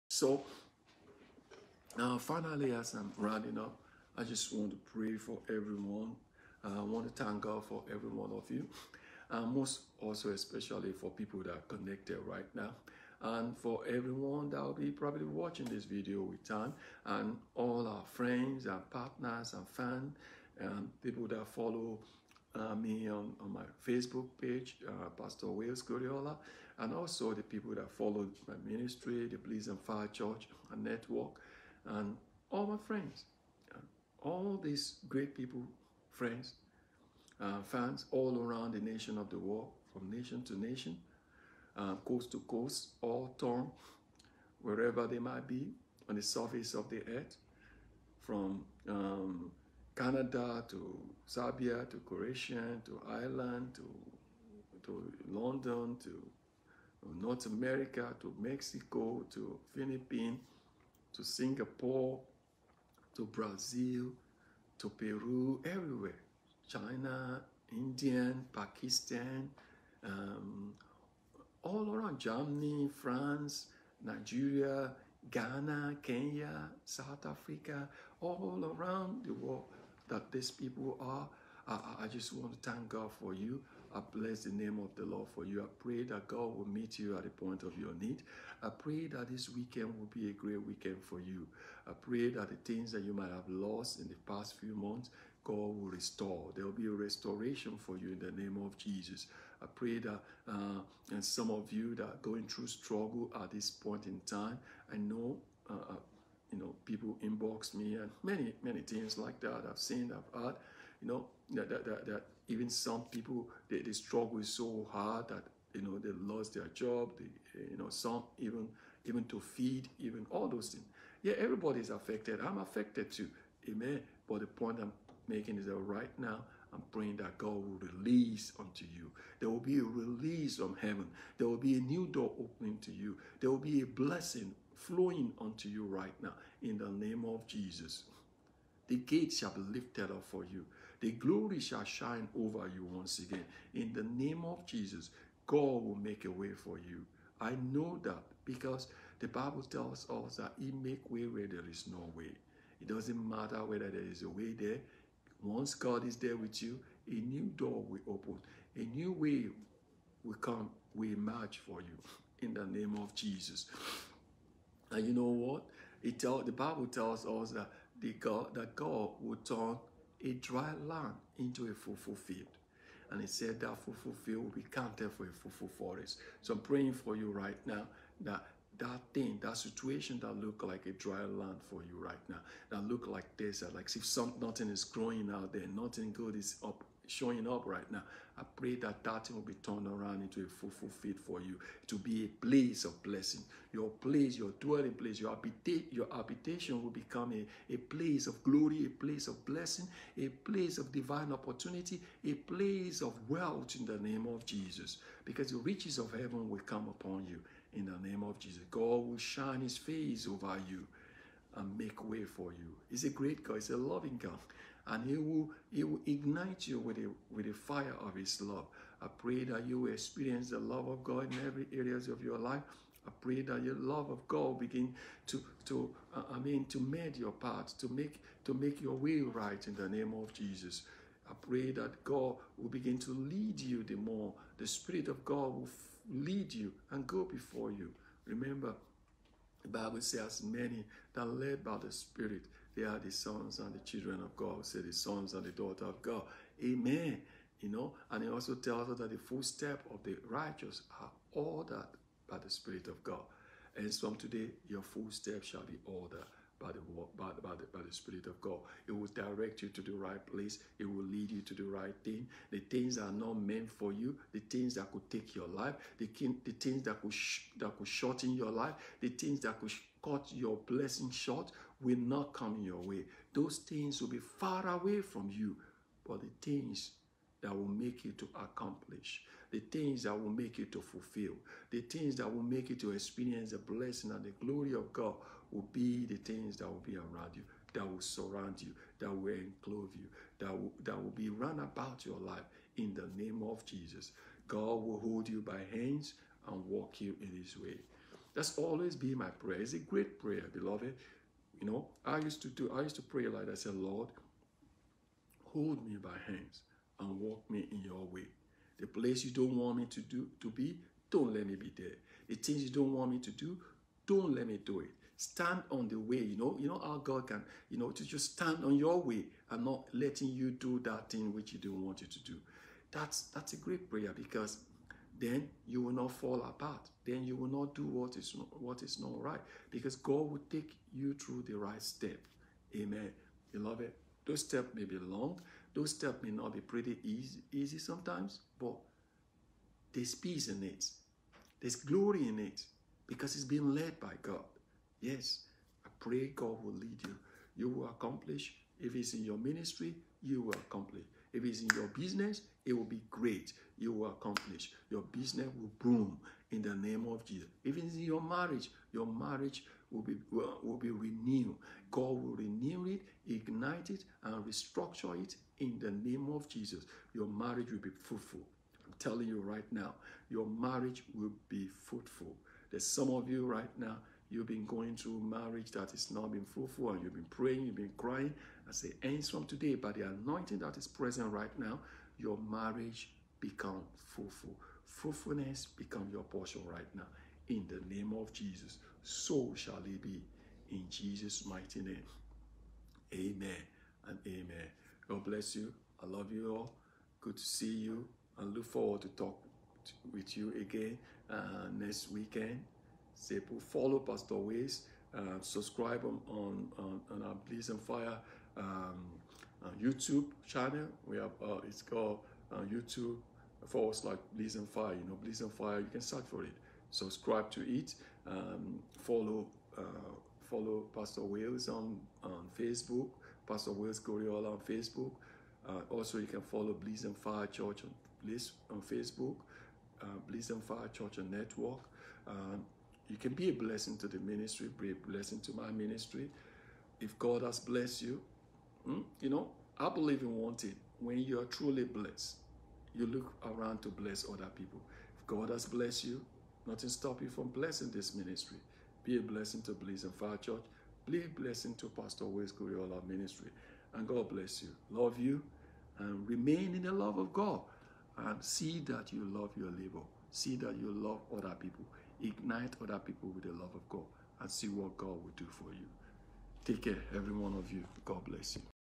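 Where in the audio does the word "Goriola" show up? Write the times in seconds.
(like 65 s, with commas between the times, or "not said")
25 s, 424 s, 452 s.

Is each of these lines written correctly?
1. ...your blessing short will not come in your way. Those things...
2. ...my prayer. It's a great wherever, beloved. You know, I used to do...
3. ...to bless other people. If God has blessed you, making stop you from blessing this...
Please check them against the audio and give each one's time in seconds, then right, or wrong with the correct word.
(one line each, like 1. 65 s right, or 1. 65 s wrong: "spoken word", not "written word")
1. 270 s right
2. 299 s wrong: "prayer", not "wherever"
3. 443 s wrong: "nothing", not "making".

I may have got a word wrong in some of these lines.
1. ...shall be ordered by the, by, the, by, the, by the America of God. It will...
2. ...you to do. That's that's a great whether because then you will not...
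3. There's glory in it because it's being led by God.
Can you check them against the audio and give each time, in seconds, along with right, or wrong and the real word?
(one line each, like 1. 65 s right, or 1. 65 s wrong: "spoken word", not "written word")
1. 255 s wrong: "Spirit", not "America"
2. 322 s wrong: "prayer", not "whether"
3. 341 s right.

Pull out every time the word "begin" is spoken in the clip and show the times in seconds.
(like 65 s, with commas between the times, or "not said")
224 s, 232 s.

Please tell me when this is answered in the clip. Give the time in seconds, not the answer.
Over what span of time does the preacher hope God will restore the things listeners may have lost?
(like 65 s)
94 s.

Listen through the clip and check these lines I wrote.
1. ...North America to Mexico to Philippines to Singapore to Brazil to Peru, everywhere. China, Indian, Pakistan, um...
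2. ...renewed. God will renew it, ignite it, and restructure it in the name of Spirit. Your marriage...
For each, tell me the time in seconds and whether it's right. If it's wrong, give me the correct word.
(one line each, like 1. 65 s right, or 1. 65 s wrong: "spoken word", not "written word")
1. 57 s right
2. 360 s wrong: "Jesus", not "Spirit".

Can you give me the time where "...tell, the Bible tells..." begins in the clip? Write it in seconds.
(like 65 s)
166 s.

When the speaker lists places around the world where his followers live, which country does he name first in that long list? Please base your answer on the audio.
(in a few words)
Canada.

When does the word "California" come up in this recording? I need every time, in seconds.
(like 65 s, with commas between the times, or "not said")
not said.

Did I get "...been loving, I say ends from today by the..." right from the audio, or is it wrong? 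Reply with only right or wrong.
wrong.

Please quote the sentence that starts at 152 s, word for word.
It doesn't matter whether there is a way there.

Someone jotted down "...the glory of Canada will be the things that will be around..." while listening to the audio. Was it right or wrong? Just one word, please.
wrong.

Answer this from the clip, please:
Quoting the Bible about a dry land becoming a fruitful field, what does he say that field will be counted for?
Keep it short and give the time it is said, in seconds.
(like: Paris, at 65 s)
a fruitful forest, at 175 s.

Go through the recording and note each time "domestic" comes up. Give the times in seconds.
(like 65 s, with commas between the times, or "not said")
not said.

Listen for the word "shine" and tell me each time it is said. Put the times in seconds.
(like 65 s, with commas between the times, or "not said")
141 s, 209 s.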